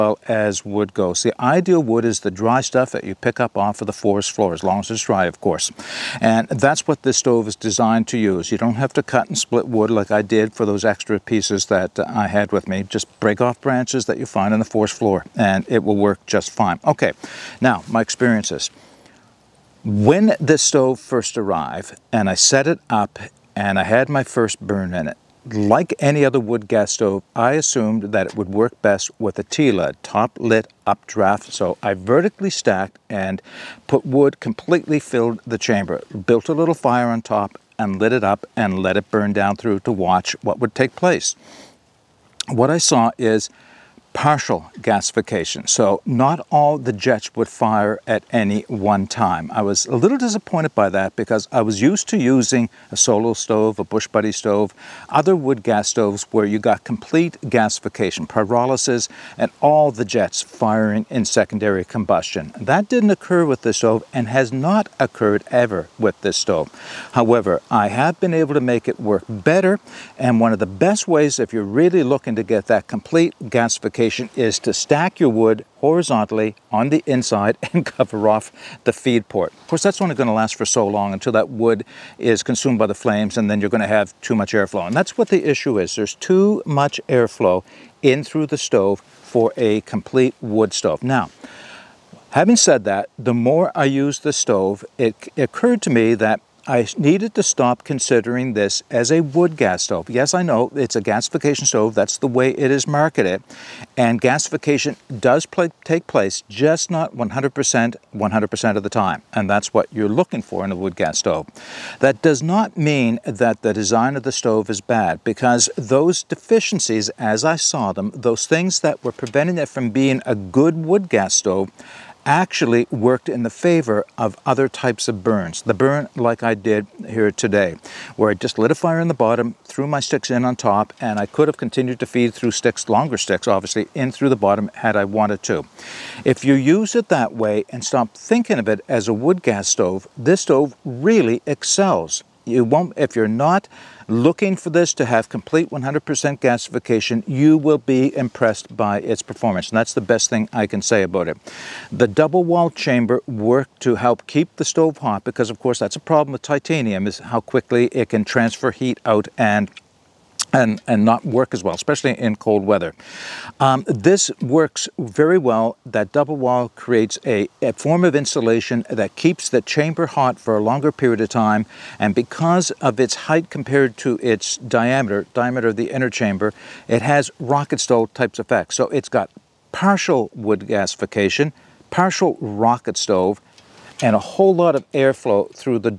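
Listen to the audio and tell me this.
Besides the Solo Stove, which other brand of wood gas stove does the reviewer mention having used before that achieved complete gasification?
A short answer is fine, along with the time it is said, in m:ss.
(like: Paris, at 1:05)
Bush Buddy, at 0:53.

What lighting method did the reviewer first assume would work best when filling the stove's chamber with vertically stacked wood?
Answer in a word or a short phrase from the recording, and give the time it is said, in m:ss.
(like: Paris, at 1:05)
top lit updraft, at 0:30.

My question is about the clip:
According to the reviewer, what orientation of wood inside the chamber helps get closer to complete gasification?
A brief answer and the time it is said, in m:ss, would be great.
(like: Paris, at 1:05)
horizontally, at 1:15.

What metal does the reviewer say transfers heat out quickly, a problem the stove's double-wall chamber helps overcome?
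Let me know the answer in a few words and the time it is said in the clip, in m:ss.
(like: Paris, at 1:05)
titanium, at 2:36.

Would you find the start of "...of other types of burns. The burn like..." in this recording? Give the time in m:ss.
2:04.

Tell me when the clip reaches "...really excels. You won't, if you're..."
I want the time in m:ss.
2:20.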